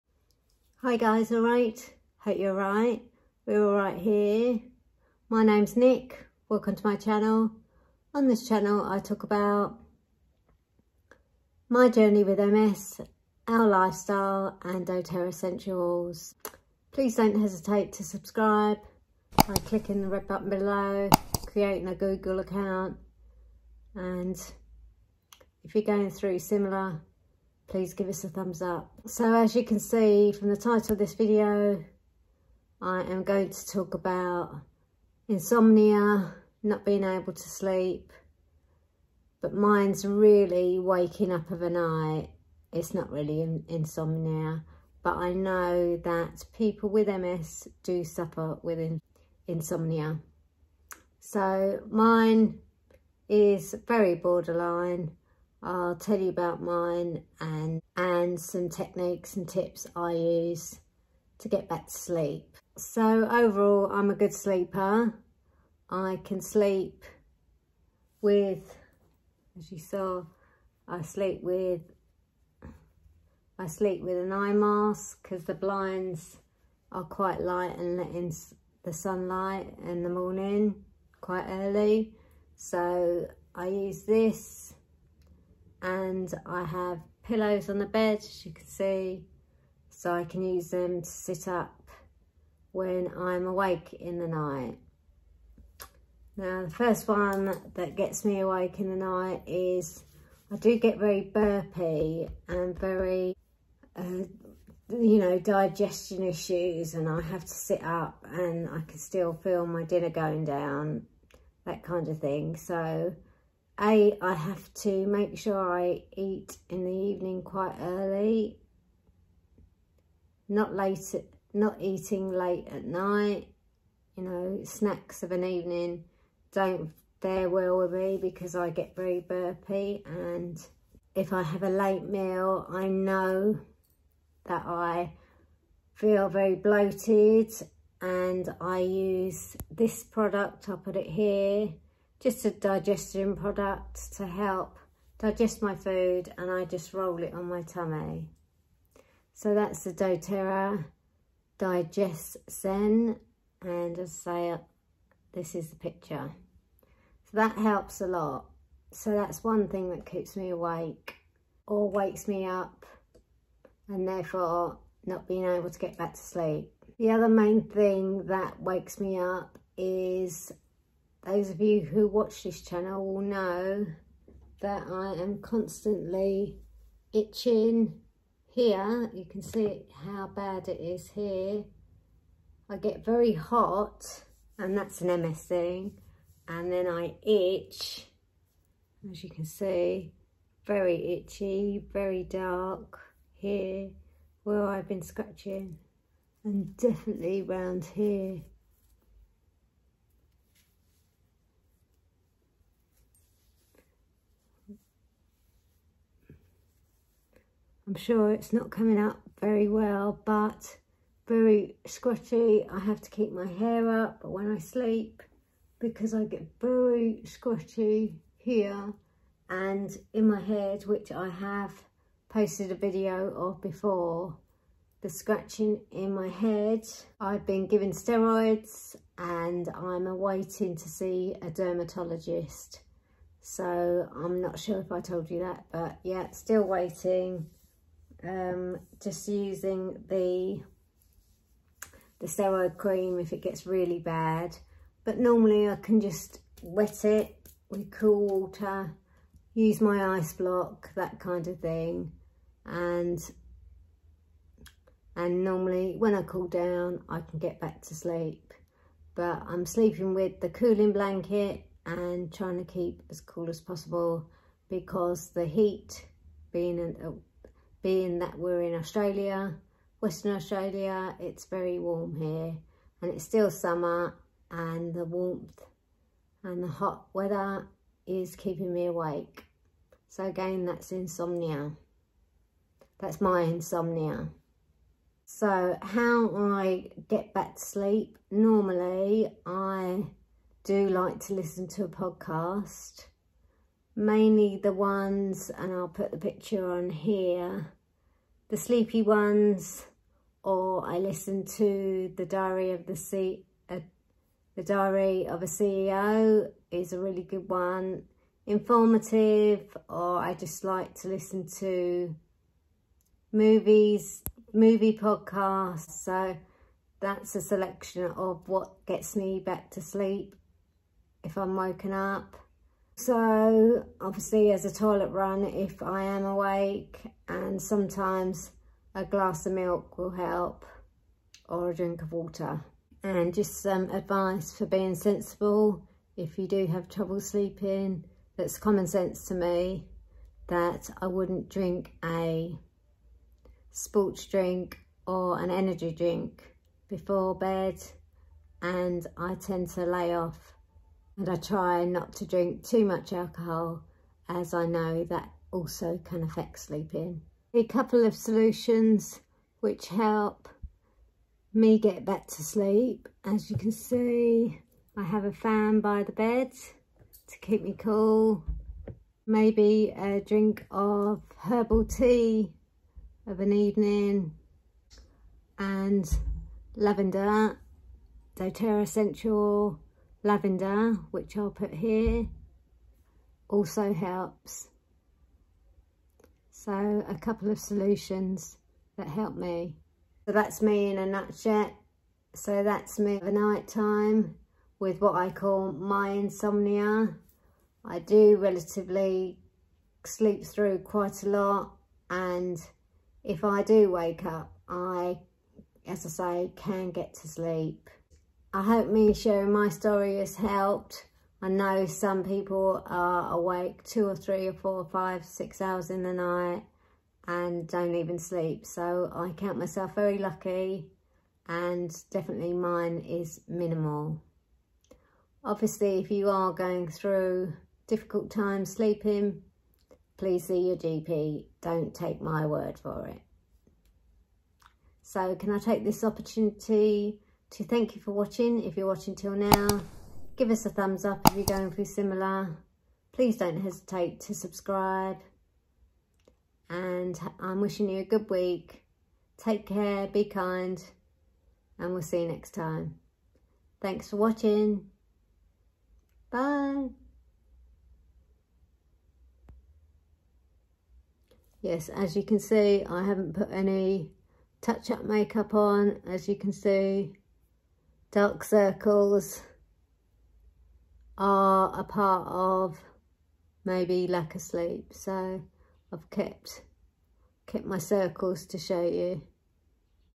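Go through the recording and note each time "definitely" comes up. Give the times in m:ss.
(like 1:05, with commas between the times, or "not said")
3:16, 7:02.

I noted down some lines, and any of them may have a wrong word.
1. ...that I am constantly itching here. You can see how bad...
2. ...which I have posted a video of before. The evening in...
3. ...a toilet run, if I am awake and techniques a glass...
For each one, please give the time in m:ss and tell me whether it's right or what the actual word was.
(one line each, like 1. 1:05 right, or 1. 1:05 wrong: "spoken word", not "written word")
1. 2:54 right
2. 3:40 wrong: "scratching", not "evening"
3. 5:24 wrong: "sometimes", not "techniques".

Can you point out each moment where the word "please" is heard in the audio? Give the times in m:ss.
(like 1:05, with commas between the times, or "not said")
0:16, 0:27, 7:10, 7:23.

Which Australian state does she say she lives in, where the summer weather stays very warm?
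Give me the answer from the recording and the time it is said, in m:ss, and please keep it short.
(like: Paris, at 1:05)
Western Australia, at 4:30.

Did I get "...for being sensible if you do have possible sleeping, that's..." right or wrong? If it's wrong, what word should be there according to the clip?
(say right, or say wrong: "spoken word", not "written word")
wrong: "trouble", not "possible".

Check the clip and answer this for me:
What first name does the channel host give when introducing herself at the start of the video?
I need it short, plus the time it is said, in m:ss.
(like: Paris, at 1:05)
Nic, at 0:05.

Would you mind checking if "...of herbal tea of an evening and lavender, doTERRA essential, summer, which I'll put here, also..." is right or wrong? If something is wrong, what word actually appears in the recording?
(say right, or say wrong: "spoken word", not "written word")
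wrong: "lavender", not "summer".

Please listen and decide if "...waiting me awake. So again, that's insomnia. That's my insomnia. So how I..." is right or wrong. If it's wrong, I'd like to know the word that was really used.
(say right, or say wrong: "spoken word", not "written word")
wrong: "keeping", not "waiting".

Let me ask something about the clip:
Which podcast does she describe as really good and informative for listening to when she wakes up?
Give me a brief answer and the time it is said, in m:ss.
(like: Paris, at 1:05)
The Diary of a CEO, at 5:04.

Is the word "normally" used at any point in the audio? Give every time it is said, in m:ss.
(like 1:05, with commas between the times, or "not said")
4:05, 4:15, 4:48.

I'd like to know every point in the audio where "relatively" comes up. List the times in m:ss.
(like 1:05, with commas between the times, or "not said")
6:38.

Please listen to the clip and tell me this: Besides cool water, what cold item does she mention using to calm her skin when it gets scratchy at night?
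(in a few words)
Ice block.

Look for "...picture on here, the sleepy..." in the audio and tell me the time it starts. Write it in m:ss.
4:56.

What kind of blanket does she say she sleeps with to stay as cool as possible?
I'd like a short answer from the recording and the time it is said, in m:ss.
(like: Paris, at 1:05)
Cooling blanket, at 4:20.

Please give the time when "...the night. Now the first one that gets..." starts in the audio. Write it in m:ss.
1:34.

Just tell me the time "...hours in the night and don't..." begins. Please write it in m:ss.
6:55.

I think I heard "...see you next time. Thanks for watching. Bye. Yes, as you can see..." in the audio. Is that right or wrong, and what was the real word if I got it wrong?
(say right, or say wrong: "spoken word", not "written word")
right.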